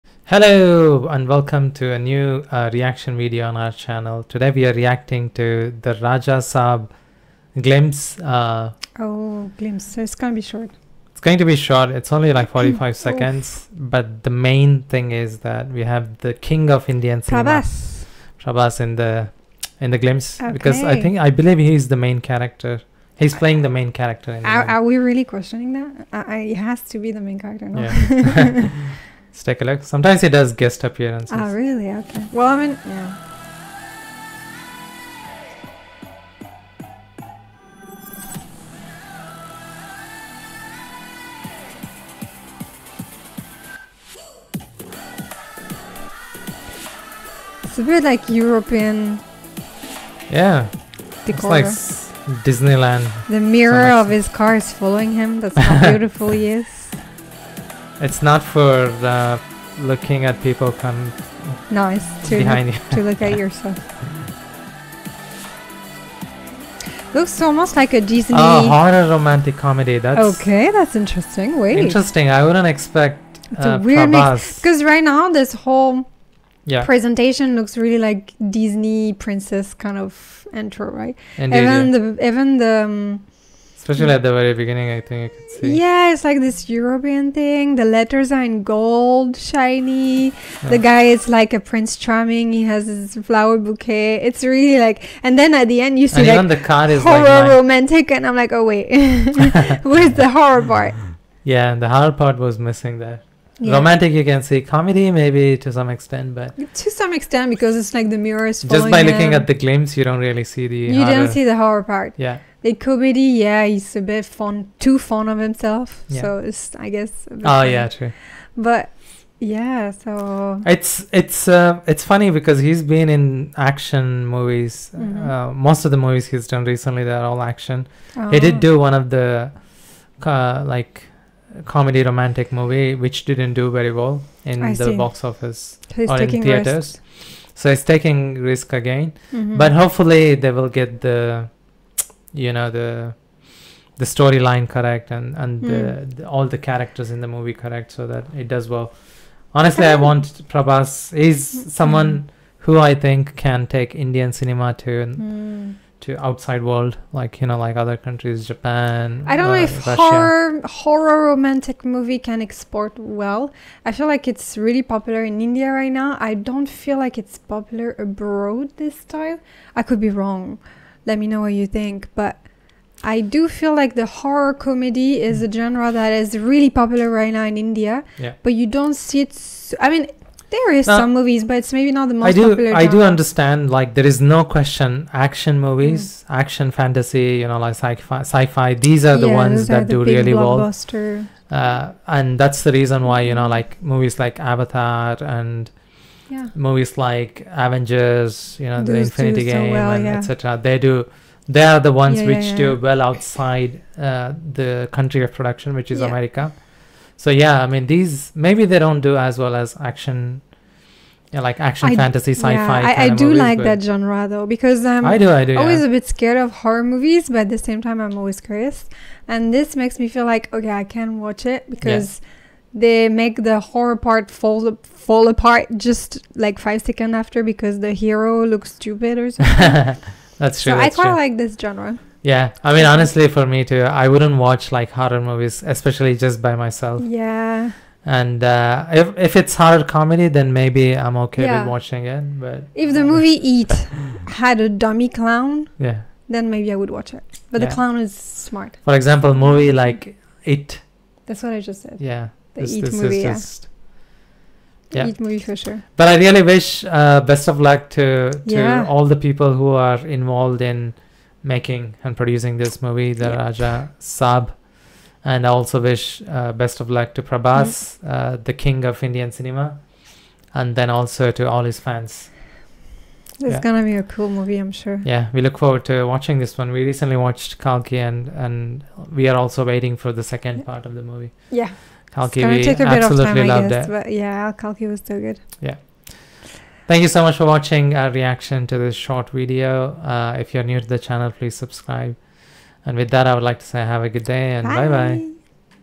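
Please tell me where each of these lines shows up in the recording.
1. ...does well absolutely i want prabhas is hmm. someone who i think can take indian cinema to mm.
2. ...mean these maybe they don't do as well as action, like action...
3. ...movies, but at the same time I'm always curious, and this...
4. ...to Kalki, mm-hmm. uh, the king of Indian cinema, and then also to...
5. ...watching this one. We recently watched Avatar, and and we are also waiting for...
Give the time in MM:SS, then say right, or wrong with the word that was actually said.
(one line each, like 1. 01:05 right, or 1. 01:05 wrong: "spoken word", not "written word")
1. 02:28 wrong: "honestly", not "absolutely"
2. 03:27 right
3. 03:36 right
4. 04:27 wrong: "Prabhas", not "Kalki"
5. 04:36 wrong: "Kalki", not "Avatar".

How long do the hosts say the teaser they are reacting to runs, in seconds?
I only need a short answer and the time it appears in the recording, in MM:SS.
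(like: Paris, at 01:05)
45 seconds, at 00:12.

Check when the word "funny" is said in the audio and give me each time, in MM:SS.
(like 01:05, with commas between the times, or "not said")
01:57, 02:02.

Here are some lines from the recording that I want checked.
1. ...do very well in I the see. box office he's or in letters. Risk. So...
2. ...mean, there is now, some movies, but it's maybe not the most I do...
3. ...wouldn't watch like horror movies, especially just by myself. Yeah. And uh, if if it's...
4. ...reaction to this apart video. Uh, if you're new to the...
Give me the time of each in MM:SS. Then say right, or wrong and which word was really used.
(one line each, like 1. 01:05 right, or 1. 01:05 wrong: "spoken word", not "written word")
1. 02:13 wrong: "theaters", not "letters"
2. 02:59 right
3. 03:54 right
4. 04:48 wrong: "short", not "apart".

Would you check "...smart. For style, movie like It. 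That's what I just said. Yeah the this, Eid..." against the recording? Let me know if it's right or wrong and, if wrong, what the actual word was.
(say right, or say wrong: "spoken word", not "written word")
wrong: "example", not "style".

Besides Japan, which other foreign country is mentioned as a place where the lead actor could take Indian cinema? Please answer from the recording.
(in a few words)
Russia.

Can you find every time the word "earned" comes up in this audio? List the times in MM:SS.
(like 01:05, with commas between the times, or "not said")
not said.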